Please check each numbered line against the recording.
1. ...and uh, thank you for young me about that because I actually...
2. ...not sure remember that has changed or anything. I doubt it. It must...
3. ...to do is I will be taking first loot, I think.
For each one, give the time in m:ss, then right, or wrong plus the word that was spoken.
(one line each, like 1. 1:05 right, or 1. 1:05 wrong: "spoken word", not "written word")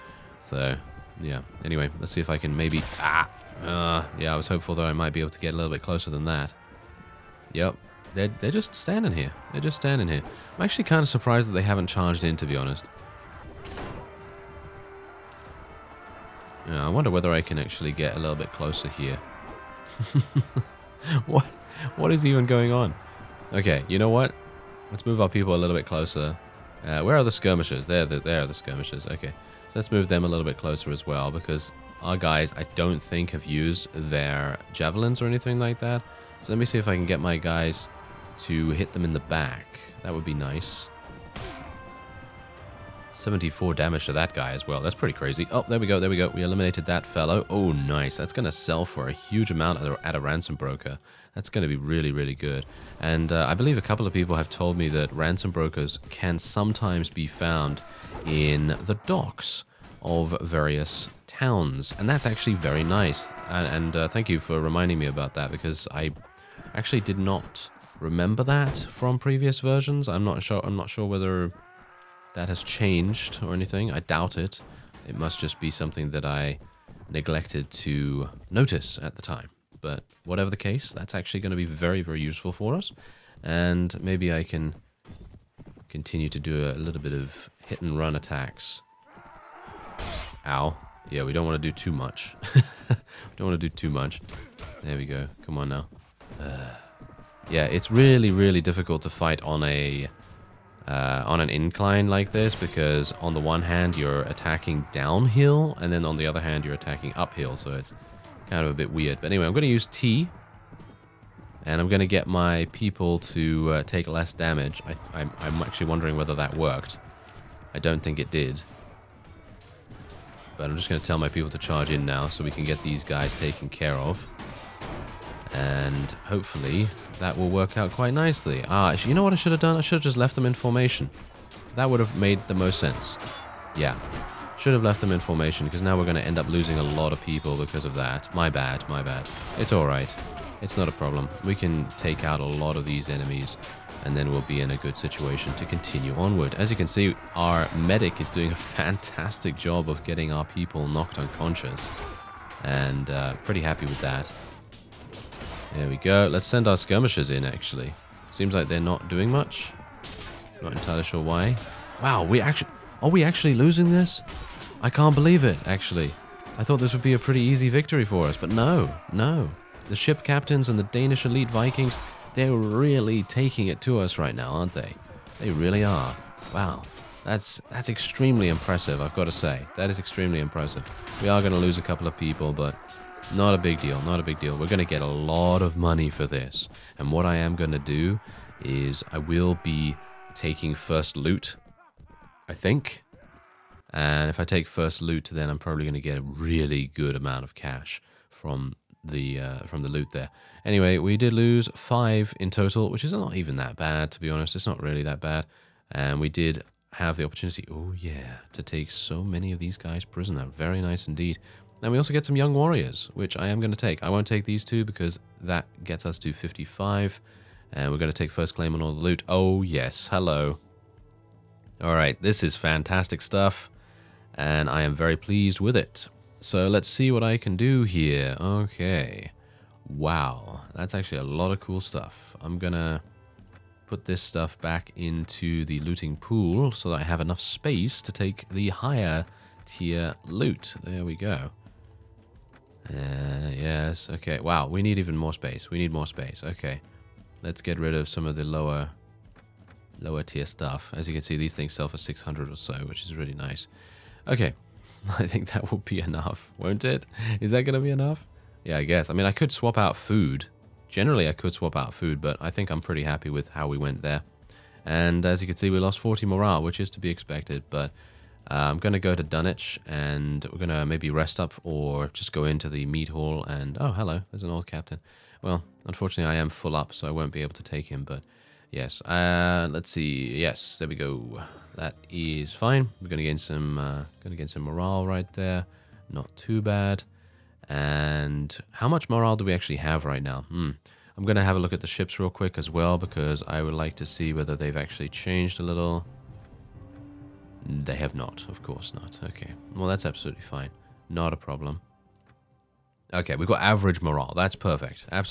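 1. 1:03 wrong: "reminding", not "young"
2. 1:10 wrong: "whether", not "remember"
3. 3:07 right.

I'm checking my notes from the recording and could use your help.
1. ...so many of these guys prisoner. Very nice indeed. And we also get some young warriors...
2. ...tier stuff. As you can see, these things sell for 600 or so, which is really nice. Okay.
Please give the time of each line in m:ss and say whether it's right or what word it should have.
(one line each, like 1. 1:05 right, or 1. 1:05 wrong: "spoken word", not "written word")
1. 3:28 right
2. 4:10 right.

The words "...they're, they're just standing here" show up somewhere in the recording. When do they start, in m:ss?
0:08.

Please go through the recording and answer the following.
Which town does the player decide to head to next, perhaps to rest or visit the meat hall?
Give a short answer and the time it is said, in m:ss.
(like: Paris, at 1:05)
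Dunwich, at 4:29.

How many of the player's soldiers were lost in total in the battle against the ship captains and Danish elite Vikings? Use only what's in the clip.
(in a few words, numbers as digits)
5.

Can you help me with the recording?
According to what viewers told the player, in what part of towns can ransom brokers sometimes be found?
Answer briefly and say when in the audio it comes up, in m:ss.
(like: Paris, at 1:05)
The docks, at 0:59.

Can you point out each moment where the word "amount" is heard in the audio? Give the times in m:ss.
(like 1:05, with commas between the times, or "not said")
0:49, 3:17.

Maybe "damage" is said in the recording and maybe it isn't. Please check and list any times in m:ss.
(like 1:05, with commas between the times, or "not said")
0:43, 1:54.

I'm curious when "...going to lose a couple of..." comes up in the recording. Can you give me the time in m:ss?
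3:01.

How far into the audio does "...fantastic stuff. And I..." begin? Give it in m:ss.
3:42.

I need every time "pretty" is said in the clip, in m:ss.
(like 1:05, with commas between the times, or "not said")
0:44, 2:33, 2:47, 4:22.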